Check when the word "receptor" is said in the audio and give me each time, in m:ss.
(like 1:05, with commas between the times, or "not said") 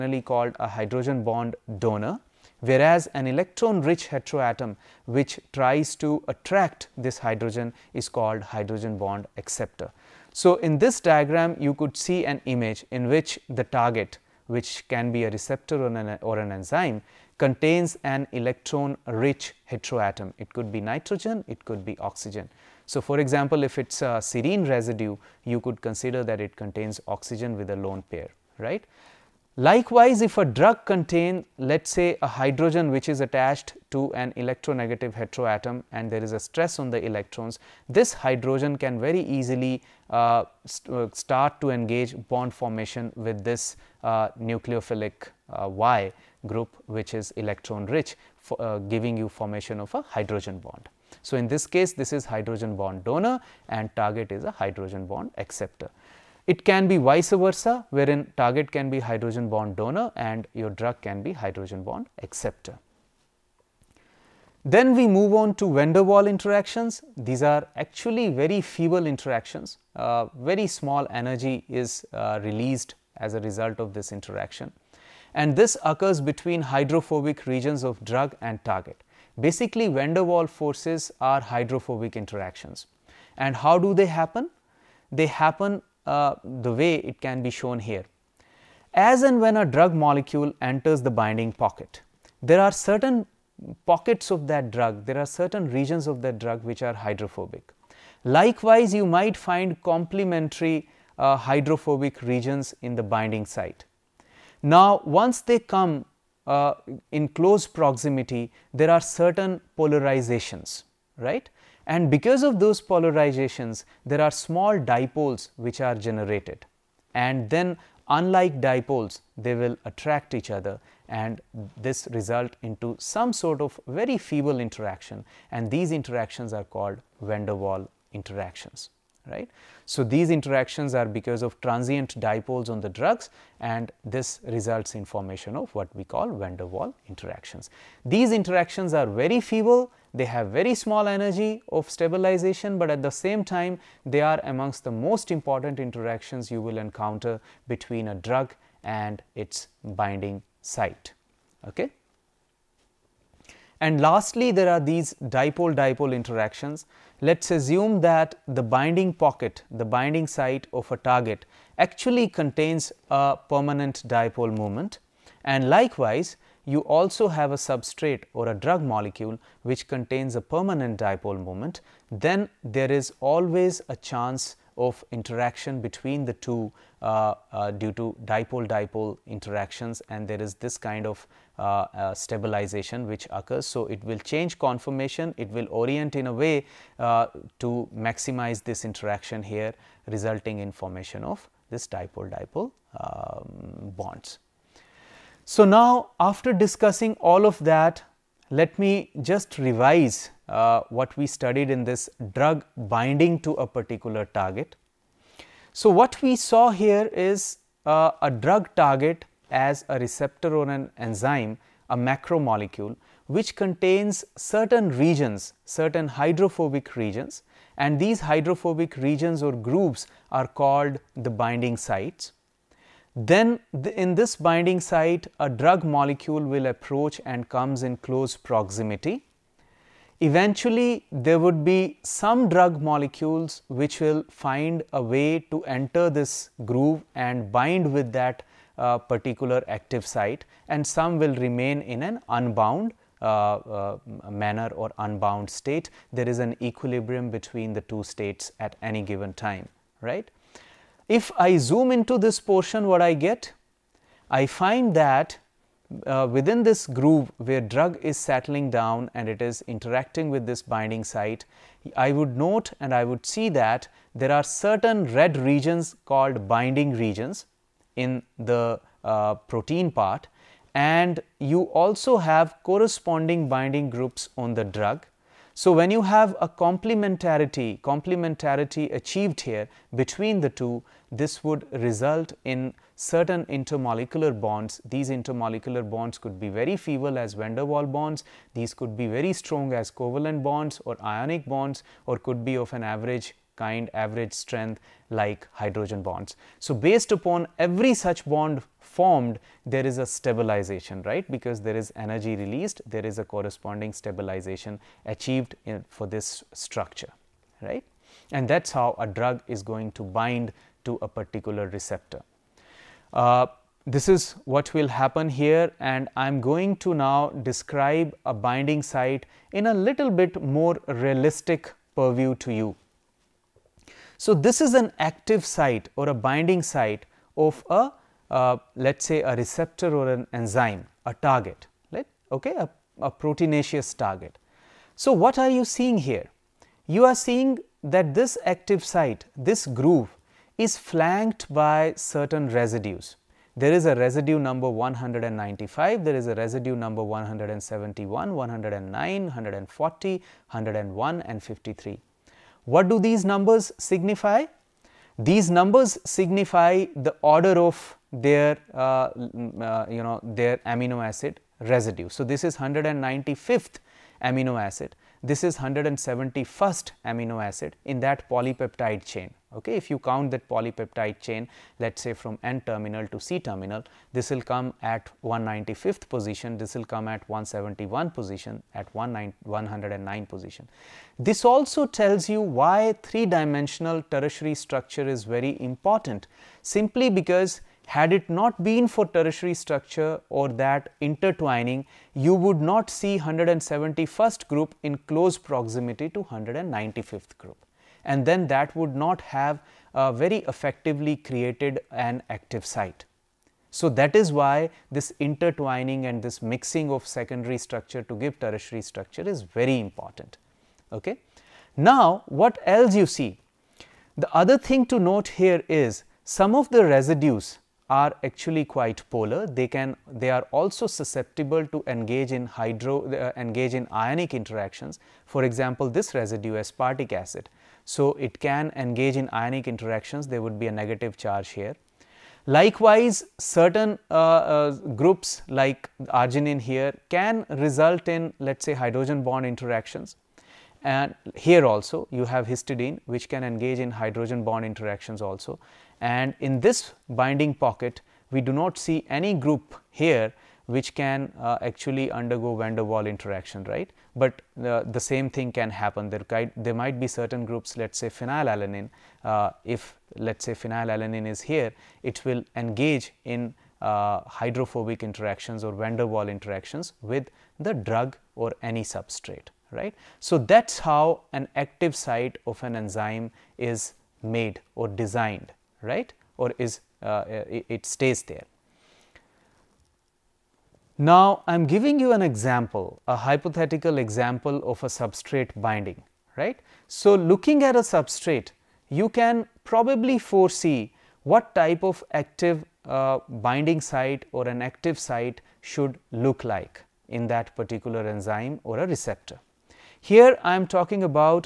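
0:15, 3:29, 5:11, 5:29, 8:18.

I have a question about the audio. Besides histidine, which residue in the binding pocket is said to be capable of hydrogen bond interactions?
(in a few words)
Arginine.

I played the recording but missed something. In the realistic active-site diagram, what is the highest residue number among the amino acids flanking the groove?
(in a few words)
195.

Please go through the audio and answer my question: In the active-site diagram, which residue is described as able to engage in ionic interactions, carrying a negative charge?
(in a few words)
Aspartic acid.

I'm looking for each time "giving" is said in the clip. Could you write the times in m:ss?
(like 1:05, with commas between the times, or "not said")
0:48, 8:01.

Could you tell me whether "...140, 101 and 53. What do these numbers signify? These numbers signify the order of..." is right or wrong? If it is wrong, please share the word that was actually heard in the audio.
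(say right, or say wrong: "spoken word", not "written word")
right.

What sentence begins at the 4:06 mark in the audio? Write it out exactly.
There is an equilibrium between the two states at any given time, right.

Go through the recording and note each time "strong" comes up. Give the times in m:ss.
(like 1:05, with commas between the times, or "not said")
4:49.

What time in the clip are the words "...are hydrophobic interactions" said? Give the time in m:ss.
1:21.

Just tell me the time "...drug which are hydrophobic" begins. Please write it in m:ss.
1:36.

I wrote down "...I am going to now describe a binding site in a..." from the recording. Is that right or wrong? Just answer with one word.
right.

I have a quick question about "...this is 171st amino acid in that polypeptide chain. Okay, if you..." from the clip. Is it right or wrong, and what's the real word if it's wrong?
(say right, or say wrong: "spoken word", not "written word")
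right.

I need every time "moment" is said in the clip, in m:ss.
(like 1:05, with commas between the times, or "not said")
2:44, 2:51.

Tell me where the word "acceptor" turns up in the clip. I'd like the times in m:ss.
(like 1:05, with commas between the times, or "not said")
0:09, 0:55, 1:02.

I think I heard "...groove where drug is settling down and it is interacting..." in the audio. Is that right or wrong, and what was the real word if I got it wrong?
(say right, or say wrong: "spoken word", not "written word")
right.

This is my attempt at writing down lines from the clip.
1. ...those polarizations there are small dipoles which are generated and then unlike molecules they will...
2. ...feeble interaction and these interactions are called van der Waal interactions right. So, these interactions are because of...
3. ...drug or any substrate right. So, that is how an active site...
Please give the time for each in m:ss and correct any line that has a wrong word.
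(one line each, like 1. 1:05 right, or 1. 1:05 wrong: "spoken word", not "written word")
1. 1:52 wrong: "dipoles", not "molecules"
2. 2:04 right
3. 7:47 right.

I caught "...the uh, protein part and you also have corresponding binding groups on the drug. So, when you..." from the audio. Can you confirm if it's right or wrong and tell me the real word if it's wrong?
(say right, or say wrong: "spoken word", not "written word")
right.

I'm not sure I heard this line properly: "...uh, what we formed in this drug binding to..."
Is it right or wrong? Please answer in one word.
wrong.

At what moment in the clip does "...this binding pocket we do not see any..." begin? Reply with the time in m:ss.
7:26.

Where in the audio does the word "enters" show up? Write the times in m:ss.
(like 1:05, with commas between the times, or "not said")
1:30, 3:55.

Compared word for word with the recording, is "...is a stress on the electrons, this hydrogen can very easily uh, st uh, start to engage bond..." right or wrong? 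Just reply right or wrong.
right.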